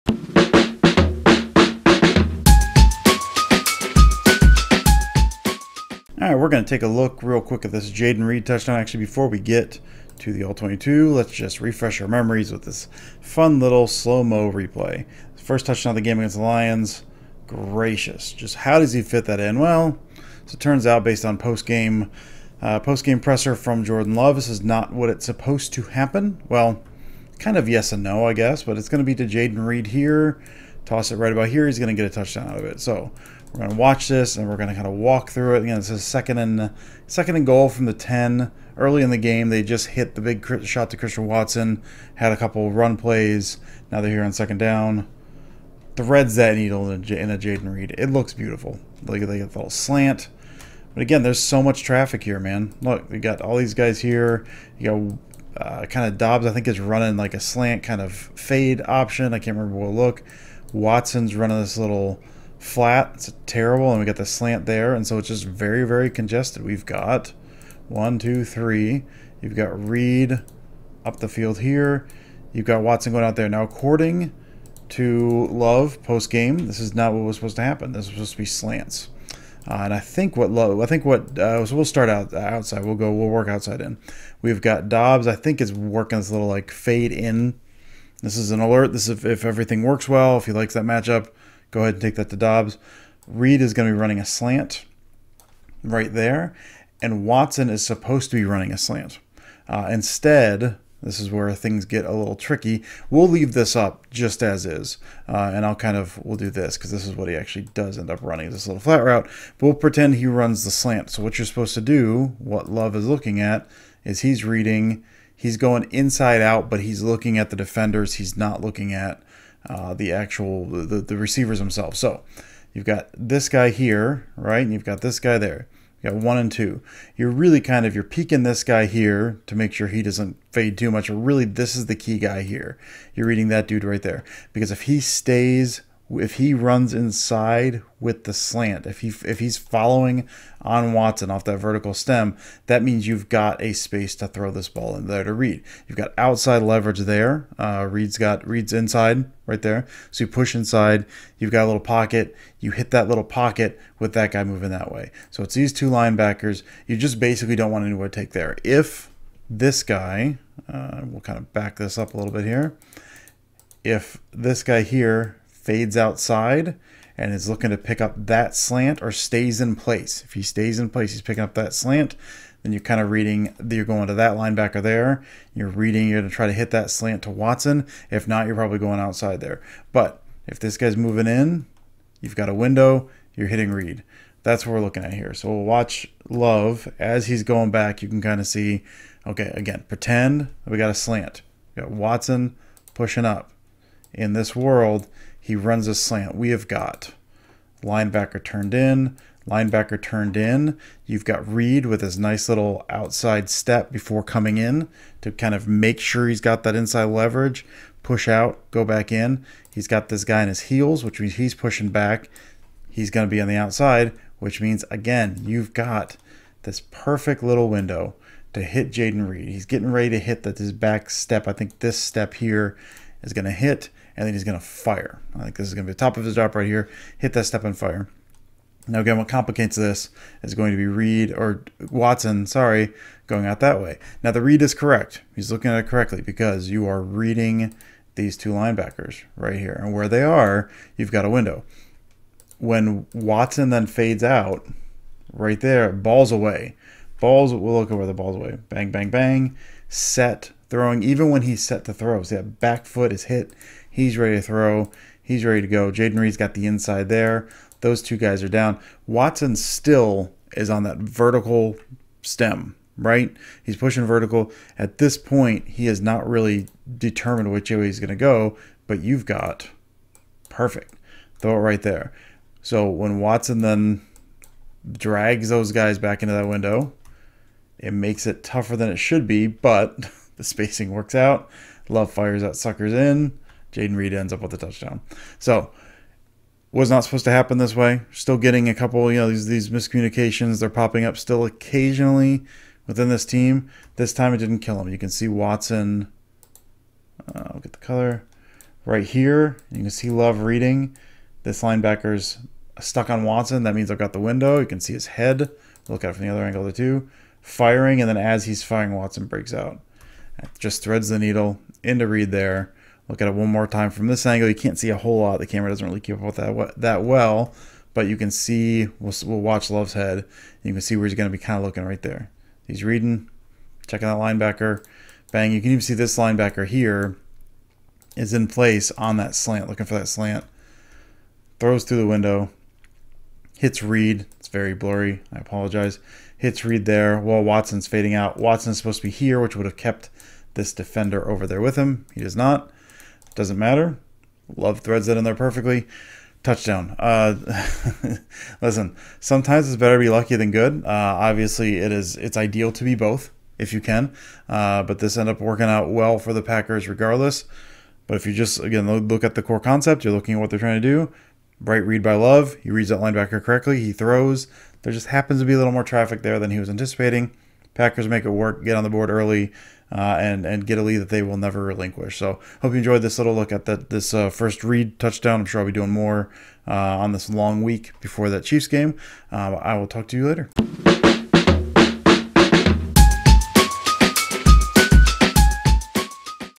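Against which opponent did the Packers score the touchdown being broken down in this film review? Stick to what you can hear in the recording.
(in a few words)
Lions.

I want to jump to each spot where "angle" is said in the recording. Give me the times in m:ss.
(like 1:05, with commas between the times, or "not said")
5:06, 5:14.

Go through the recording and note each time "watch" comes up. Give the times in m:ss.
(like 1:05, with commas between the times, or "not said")
0:33, 3:05, 5:19.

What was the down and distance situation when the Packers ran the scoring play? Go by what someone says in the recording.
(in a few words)
Second and goal from the 10.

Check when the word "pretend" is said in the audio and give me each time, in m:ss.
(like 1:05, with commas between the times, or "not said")
1:49, 3:09.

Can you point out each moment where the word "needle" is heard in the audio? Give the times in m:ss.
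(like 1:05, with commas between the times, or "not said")
0:46, 5:11.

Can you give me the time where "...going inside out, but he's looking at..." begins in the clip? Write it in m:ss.
1:55.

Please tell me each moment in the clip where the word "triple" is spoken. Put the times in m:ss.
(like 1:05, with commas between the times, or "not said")
not said.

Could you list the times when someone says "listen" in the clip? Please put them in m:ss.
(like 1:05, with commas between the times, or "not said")
5:48.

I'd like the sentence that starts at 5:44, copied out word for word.
Love threads that in there perfectly.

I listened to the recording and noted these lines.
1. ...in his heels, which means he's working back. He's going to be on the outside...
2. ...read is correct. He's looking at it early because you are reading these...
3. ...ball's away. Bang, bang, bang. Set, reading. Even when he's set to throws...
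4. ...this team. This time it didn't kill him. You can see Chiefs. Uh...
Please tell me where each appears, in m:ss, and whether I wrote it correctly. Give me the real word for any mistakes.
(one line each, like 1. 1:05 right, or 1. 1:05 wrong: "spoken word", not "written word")
1. 3:30 wrong: "pushing", not "working"
2. 3:54 wrong: "correctly", not "early"
3. 4:08 wrong: "throwing", not "reading"
4. 4:53 wrong: "Watson", not "Chiefs".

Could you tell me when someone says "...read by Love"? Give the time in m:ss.
6:01.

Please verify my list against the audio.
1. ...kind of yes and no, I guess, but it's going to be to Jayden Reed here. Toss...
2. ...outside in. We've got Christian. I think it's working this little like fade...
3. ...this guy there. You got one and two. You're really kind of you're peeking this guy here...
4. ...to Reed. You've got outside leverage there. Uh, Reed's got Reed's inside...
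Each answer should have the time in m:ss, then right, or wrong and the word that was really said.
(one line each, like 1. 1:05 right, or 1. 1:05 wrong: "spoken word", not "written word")
1. 0:27 right
2. 1:23 wrong: "Doubs", not "Christian"
3. 2:05 right
4. 2:25 right.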